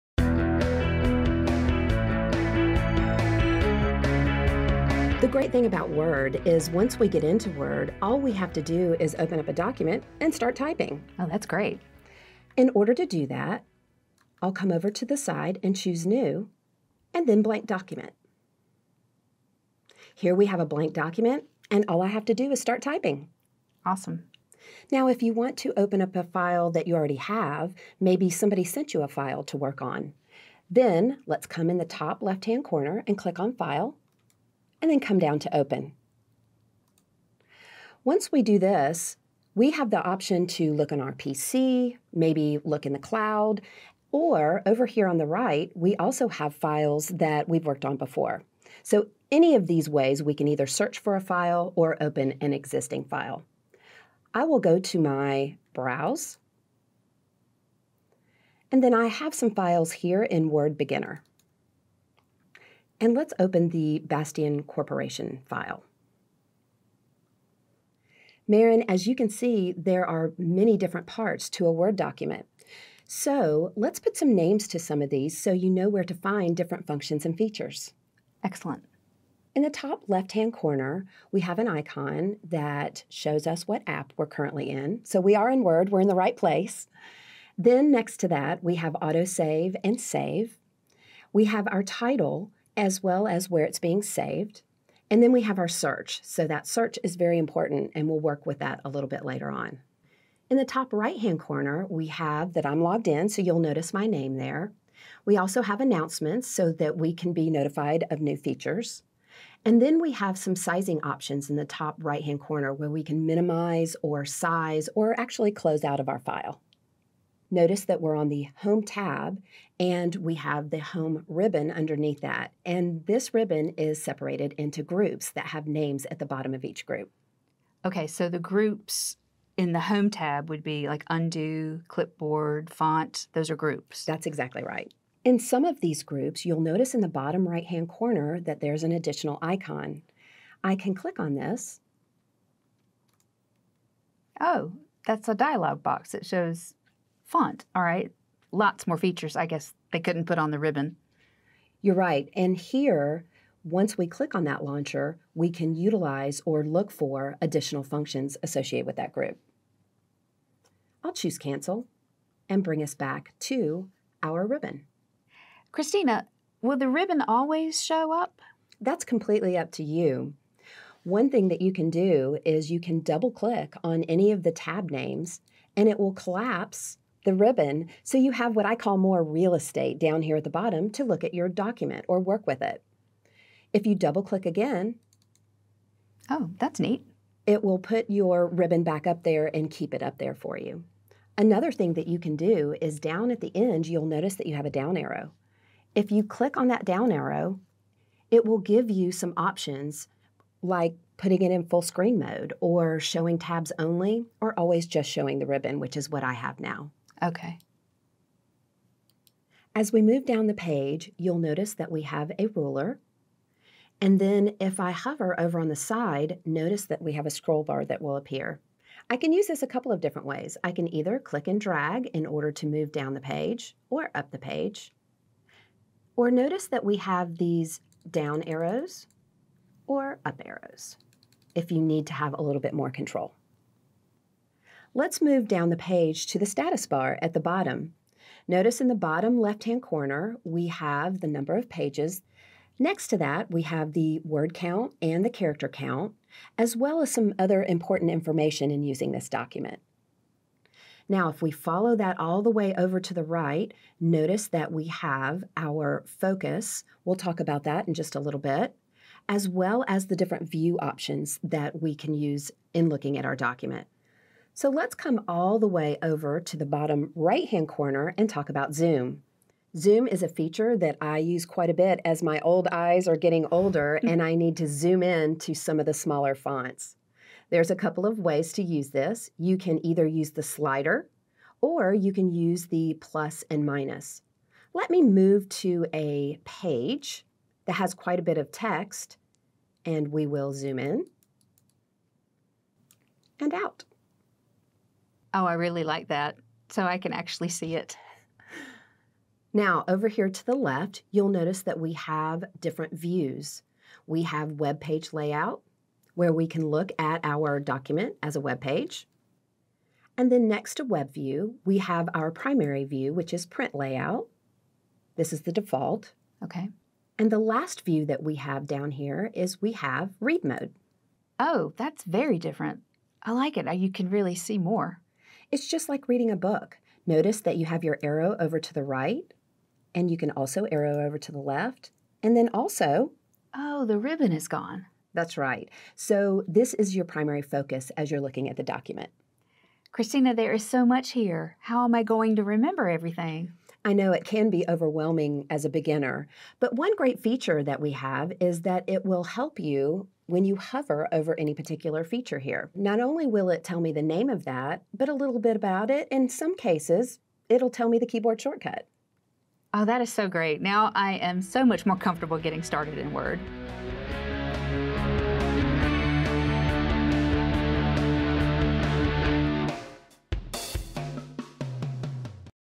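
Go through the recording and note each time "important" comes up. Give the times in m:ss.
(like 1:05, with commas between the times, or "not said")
1:37, 4:07.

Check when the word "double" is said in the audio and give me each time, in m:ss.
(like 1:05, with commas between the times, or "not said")
2:52, 3:03.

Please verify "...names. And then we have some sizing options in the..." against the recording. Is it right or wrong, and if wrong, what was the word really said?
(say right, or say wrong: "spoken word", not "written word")
wrong: "features", not "names".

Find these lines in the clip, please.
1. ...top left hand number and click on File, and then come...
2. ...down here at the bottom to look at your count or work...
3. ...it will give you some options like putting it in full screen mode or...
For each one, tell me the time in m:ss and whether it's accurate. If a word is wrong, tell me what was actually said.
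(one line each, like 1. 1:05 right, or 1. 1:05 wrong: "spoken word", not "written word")
1. 0:31 wrong: "corner", not "number"
2. 2:59 wrong: "document", not "count"
3. 3:18 right.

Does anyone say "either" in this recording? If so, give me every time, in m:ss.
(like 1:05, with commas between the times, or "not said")
0:50, 3:40, 4:39.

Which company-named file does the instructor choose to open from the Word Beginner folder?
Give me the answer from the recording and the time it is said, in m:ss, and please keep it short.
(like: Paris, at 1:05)
Bastian Corporation, at 1:04.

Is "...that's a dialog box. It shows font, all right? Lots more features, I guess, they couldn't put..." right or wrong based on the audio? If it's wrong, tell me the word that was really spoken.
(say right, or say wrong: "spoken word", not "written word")
right.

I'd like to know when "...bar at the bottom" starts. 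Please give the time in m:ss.
3:56.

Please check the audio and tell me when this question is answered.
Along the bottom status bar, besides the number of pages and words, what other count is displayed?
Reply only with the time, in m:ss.
4:05.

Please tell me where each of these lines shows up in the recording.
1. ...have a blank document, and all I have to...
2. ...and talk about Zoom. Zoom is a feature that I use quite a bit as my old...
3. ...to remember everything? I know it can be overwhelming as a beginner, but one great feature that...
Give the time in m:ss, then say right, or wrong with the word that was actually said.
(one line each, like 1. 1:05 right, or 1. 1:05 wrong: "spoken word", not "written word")
1. 0:20 right
2. 4:28 right
3. 5:42 right.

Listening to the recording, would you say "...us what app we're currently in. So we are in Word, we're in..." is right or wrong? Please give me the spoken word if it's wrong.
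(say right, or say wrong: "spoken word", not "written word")
right.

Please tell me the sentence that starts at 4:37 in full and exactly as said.
There's a couple of ways to use this.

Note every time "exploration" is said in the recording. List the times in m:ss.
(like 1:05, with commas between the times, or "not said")
not said.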